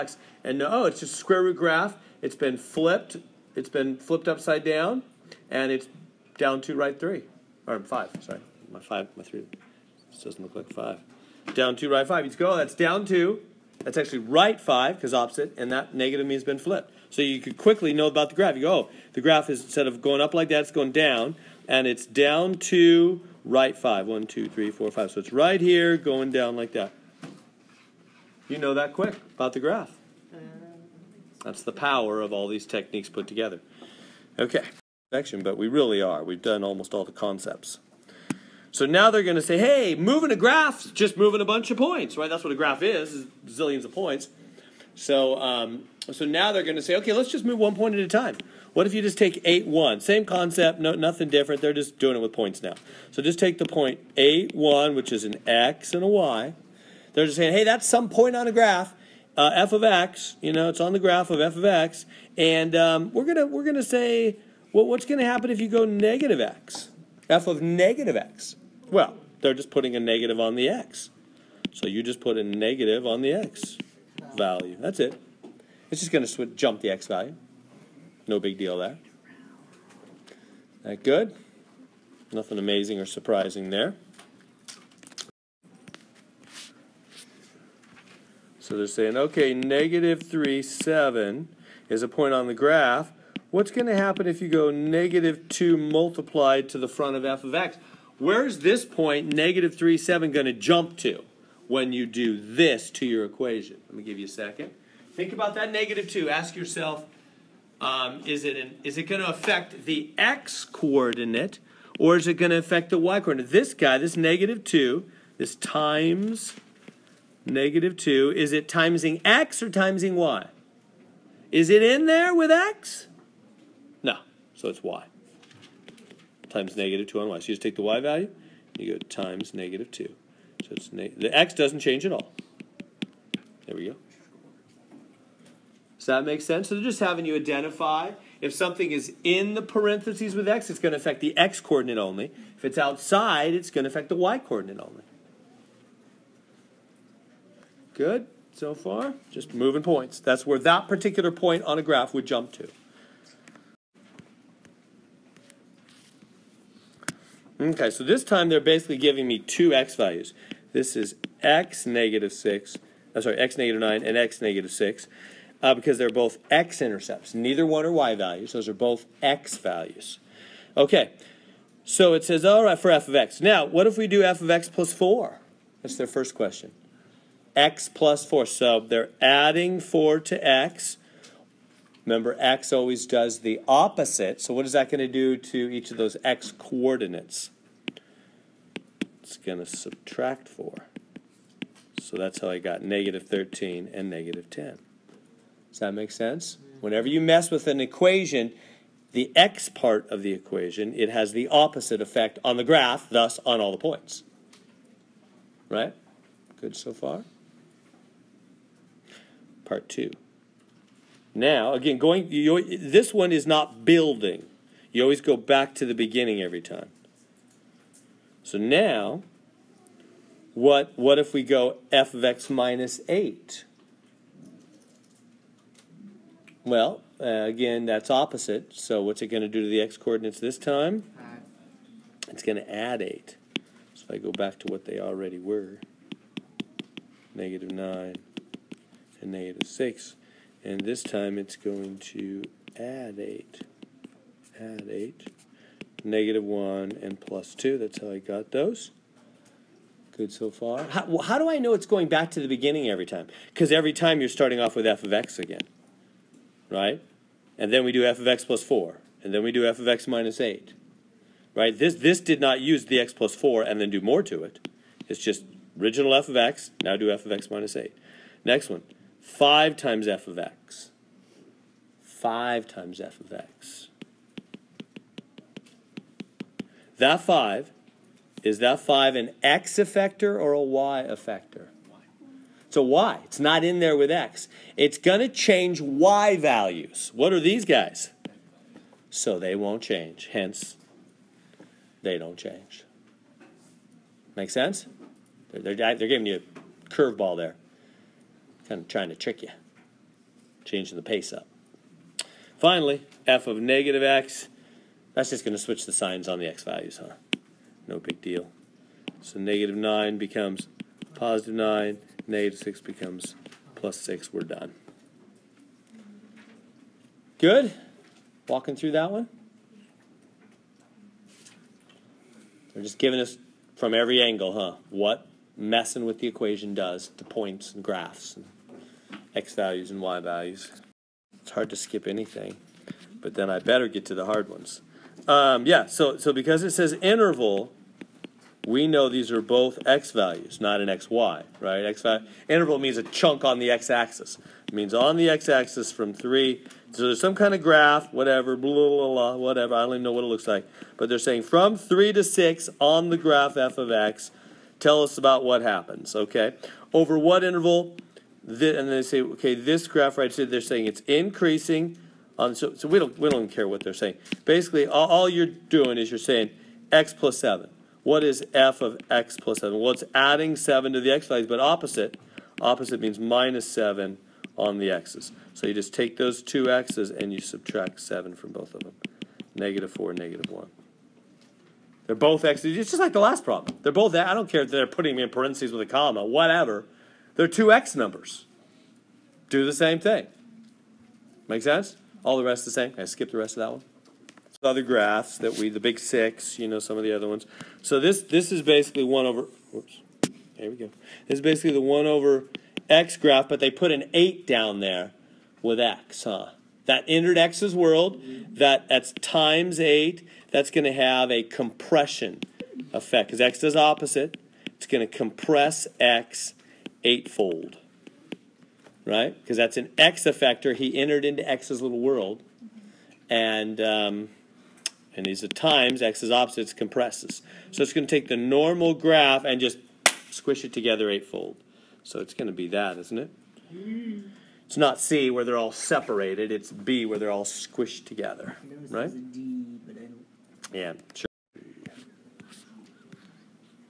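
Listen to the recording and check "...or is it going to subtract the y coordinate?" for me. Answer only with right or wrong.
wrong.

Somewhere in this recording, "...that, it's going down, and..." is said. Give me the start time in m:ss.
0:20.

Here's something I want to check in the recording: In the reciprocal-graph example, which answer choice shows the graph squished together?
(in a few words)
B.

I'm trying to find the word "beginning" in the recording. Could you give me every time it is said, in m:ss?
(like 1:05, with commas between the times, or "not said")
3:35, 4:12.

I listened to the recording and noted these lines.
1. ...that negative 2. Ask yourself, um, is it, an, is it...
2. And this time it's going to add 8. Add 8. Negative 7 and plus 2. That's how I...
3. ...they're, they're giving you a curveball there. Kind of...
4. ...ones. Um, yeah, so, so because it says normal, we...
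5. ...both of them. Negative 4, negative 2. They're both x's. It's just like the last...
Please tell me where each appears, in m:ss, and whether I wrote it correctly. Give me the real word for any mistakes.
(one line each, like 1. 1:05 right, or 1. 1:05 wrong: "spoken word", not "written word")
1. 1:45 right
2. 4:00 wrong: "1", not "7"
3. 4:55 right
4. 5:34 wrong: "interval", not "normal"
5. 6:18 wrong: "1", not "2".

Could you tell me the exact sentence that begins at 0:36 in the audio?
We've done almost all the concepts.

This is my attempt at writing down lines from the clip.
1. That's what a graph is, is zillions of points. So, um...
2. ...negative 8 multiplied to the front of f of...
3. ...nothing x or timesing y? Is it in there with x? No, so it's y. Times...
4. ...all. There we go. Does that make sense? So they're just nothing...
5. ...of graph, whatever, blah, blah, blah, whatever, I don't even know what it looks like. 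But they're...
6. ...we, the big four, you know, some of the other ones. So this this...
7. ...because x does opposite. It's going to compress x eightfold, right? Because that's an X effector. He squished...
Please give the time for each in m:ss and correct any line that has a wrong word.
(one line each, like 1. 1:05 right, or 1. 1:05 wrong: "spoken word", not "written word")
1. 0:42 right
2. 1:34 wrong: "2", not "8"
3. 1:58 wrong: "timesing", not "nothing"
4. 2:12 wrong: "having", not "nothing"
5. 5:47 right
6. 6:35 wrong: "six", not "four"
7. 6:53 wrong: "entered", not "squished".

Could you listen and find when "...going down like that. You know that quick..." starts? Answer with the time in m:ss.
0:25.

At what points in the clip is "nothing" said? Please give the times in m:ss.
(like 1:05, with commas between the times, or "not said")
0:50, 1:22.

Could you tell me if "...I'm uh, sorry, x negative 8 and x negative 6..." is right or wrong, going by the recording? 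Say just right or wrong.
wrong.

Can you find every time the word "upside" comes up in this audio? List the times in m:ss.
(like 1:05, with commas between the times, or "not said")
0:04.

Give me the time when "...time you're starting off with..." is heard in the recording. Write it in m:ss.
4:13.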